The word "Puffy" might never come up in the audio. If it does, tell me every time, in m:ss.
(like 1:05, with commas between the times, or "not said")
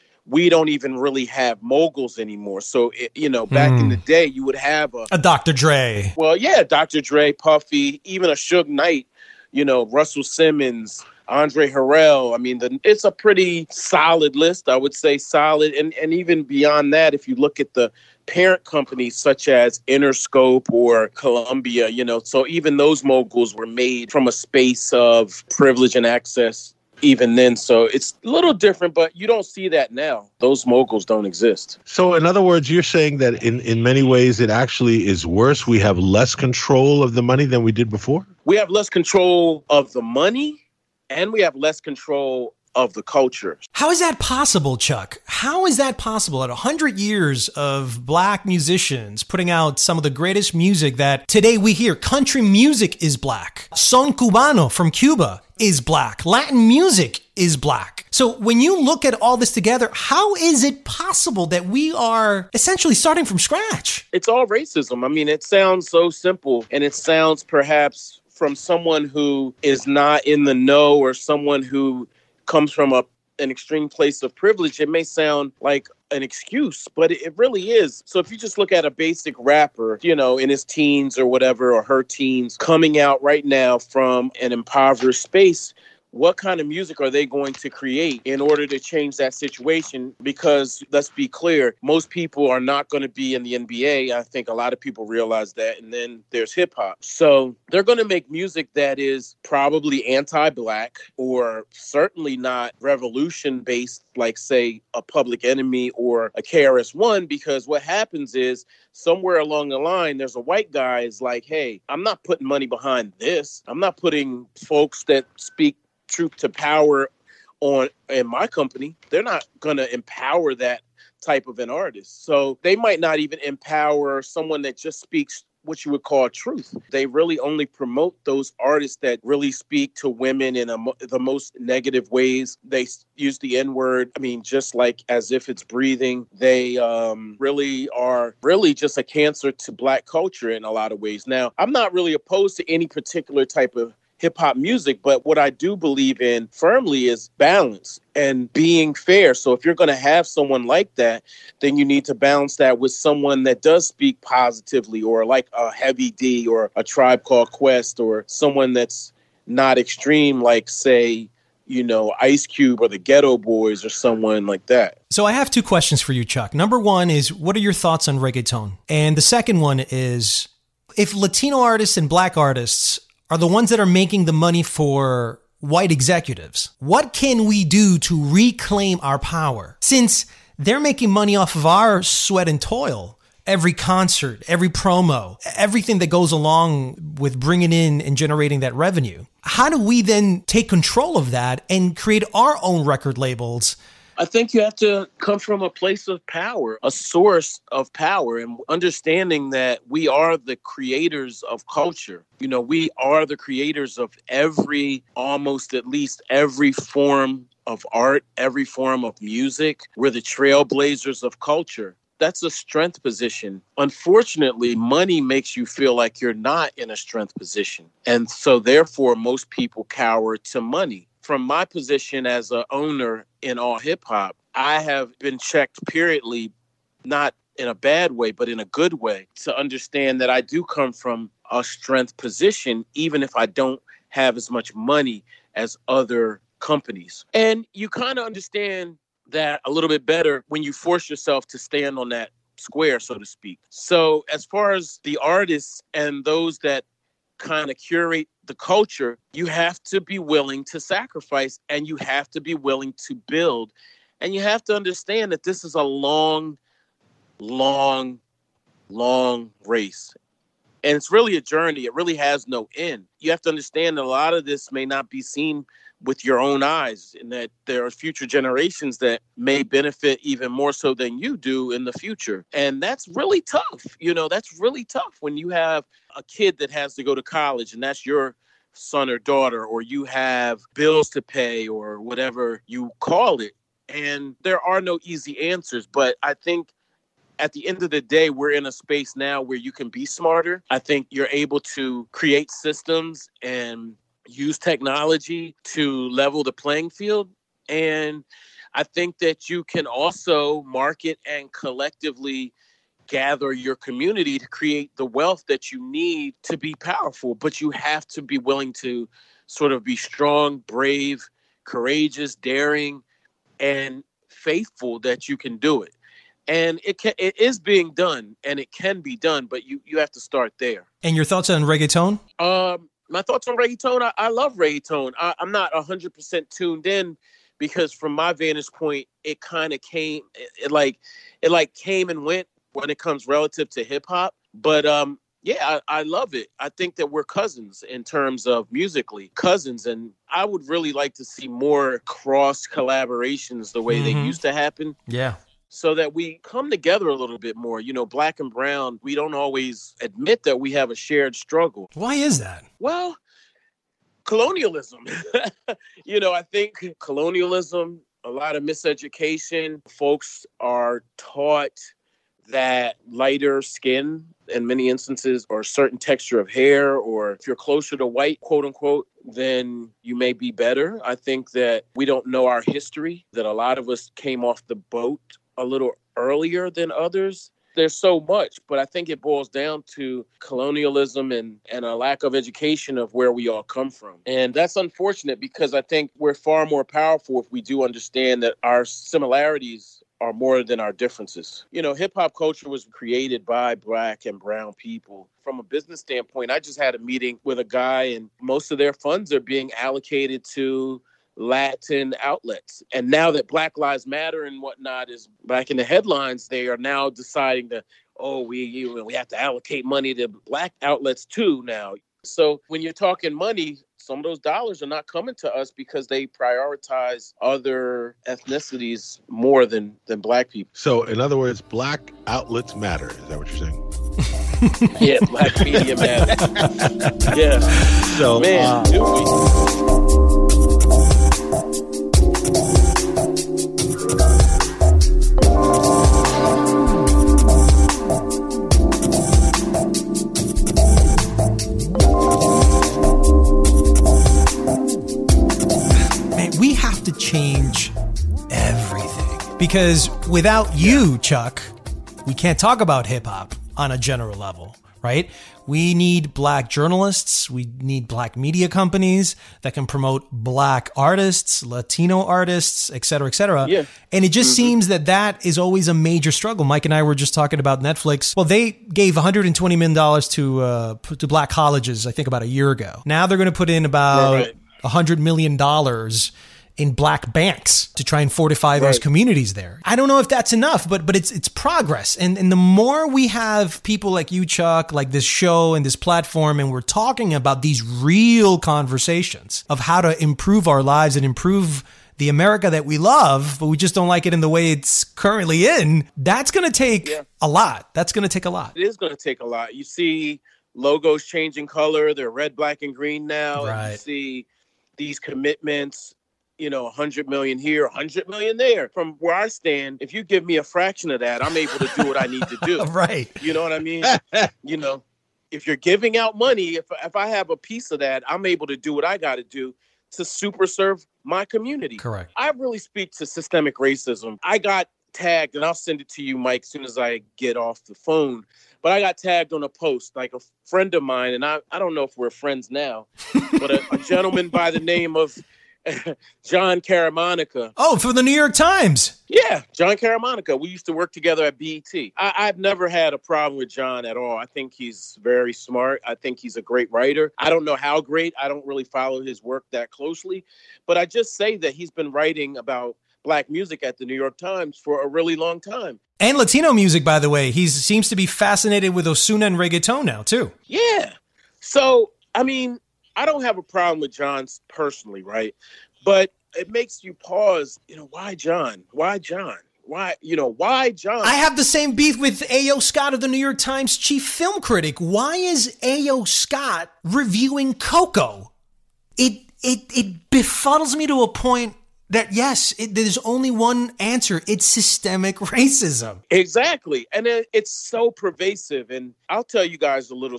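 0:07.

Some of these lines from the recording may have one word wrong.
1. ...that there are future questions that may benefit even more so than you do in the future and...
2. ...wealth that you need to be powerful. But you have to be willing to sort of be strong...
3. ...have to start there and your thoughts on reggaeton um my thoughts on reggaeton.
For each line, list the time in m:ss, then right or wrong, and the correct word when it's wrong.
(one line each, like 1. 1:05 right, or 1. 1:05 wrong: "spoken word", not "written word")
1. 4:27 wrong: "generations", not "questions"
2. 5:05 right
3. 5:19 right.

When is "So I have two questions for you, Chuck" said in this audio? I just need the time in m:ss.
2:45.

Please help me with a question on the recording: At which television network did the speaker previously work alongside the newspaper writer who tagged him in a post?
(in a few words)
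BET.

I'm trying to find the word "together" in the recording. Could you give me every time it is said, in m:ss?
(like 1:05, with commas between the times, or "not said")
0:59, 5:46, 9:01.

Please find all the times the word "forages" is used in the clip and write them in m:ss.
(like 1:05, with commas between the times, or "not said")
not said.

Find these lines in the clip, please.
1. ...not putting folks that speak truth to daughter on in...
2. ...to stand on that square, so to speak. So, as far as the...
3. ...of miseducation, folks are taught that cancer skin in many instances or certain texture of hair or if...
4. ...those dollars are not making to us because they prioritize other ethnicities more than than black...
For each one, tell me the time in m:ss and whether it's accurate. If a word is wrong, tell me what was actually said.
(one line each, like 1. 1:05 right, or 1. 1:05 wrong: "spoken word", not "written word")
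1. 1:53 wrong: "power", not "daughter"
2. 4:01 right
3. 5:58 wrong: "lighter", not "cancer"
4. 6:54 wrong: "coming", not "making".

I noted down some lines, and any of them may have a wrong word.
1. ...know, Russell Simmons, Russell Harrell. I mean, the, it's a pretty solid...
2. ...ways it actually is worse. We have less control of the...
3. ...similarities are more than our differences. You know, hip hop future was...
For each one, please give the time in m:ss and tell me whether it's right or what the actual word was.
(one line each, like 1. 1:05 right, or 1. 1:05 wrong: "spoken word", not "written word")
1. 0:09 wrong: "Andre", not "Russell"
2. 0:34 right
3. 6:28 wrong: "culture", not "future".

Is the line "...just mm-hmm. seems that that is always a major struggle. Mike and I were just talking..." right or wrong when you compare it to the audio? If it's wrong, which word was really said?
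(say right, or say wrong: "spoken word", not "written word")
right.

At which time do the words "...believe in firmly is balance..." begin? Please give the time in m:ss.
2:25.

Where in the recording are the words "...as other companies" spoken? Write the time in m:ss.
3:55.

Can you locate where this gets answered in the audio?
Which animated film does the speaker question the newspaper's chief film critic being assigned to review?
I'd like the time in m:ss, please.
9:37.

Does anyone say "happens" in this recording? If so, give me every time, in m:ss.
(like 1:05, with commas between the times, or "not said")
1:47, 5:44.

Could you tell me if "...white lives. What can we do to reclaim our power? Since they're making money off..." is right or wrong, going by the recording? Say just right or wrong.
wrong.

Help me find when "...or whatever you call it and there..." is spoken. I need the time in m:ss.
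4:41.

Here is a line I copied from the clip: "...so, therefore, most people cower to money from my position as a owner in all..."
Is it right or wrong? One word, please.
right.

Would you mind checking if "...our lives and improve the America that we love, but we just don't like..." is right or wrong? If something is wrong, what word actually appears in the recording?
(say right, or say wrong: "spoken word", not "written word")
right.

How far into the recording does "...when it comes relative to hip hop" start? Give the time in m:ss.
5:32.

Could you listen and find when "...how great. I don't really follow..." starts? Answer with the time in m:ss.
9:07.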